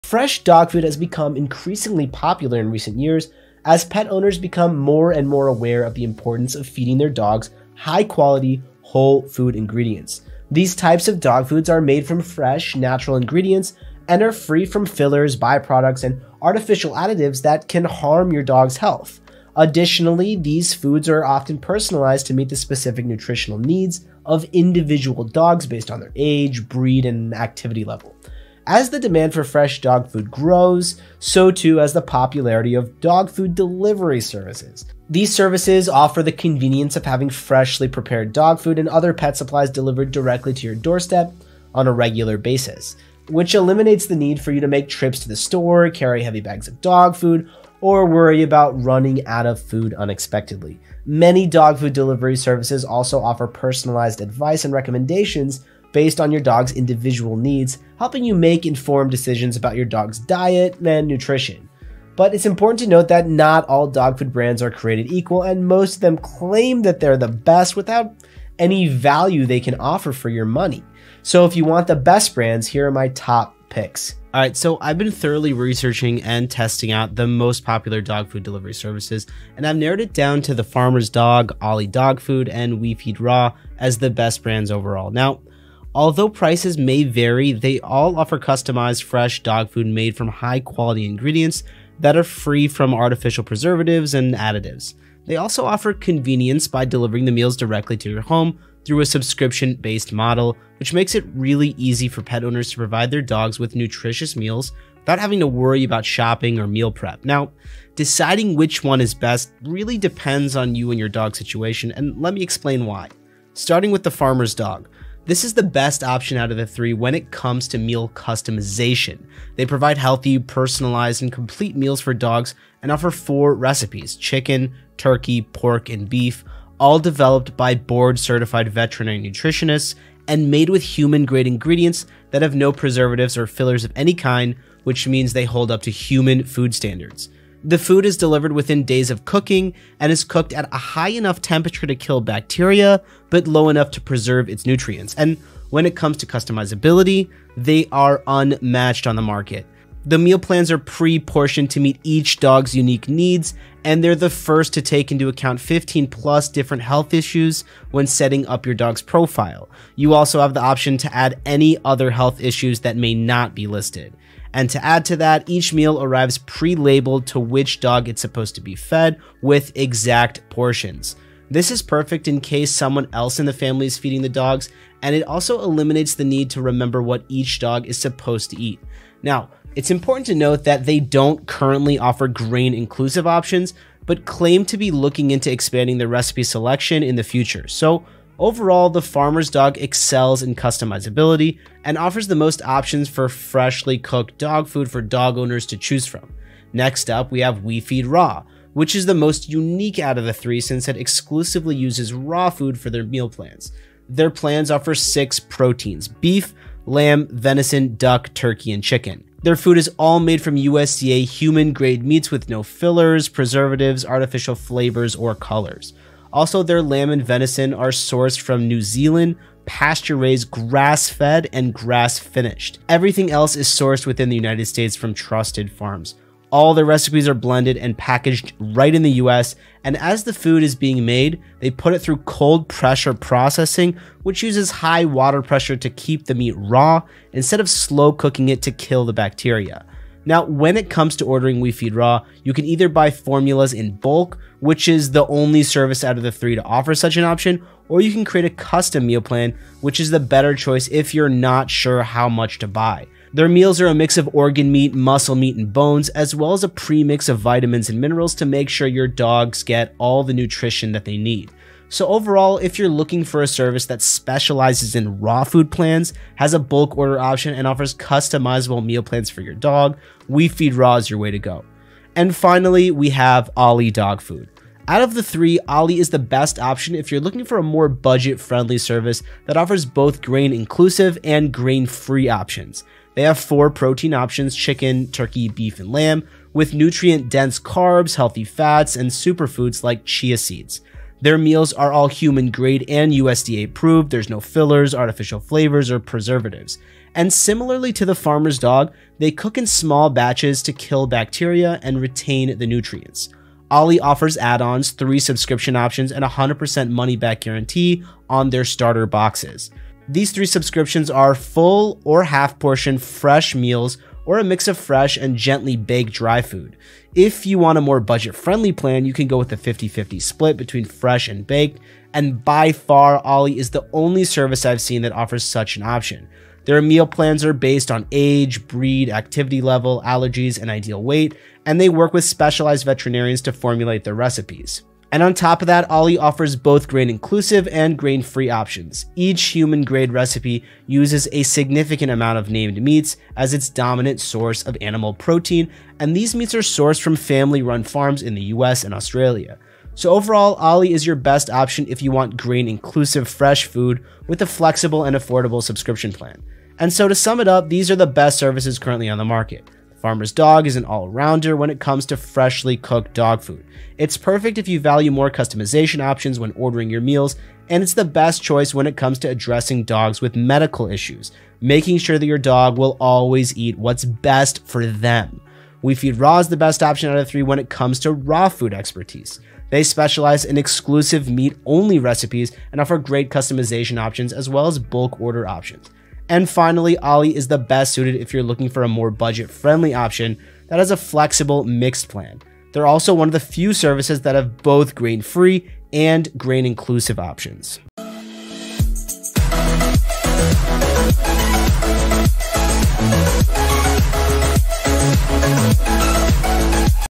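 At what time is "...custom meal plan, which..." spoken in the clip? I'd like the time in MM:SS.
04:08.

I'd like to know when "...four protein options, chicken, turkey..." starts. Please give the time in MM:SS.
04:43.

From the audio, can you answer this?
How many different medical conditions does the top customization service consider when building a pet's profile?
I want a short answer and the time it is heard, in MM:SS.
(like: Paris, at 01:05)
15+, at 02:35.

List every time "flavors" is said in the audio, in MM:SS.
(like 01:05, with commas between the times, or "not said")
03:34, 04:55.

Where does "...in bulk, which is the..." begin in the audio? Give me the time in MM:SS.
04:03.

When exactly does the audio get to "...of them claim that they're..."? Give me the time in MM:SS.
01:05.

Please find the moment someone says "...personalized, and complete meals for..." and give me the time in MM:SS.
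02:00.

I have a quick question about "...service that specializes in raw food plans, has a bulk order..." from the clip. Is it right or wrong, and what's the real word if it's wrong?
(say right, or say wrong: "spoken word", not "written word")
right.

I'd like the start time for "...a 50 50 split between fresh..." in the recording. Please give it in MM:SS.
05:19.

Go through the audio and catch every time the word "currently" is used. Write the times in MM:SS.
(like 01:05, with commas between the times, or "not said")
03:01, 05:58.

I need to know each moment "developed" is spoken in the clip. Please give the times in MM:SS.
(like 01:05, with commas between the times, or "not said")
02:06.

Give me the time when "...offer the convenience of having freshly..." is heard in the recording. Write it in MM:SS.
00:35.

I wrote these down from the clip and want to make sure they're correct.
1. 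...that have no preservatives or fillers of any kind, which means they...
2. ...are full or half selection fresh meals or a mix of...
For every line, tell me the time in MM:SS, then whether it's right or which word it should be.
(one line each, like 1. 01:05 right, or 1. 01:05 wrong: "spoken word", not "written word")
1. 02:12 right
2. 05:11 wrong: "portion", not "selection".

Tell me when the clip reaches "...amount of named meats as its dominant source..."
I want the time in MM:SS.
05:42.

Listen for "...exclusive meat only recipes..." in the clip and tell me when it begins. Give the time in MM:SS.
06:20.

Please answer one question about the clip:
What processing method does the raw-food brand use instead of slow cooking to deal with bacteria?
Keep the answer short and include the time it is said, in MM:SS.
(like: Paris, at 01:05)
Cold pressure processing, at 03:52.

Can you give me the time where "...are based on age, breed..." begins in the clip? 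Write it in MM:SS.
05:27.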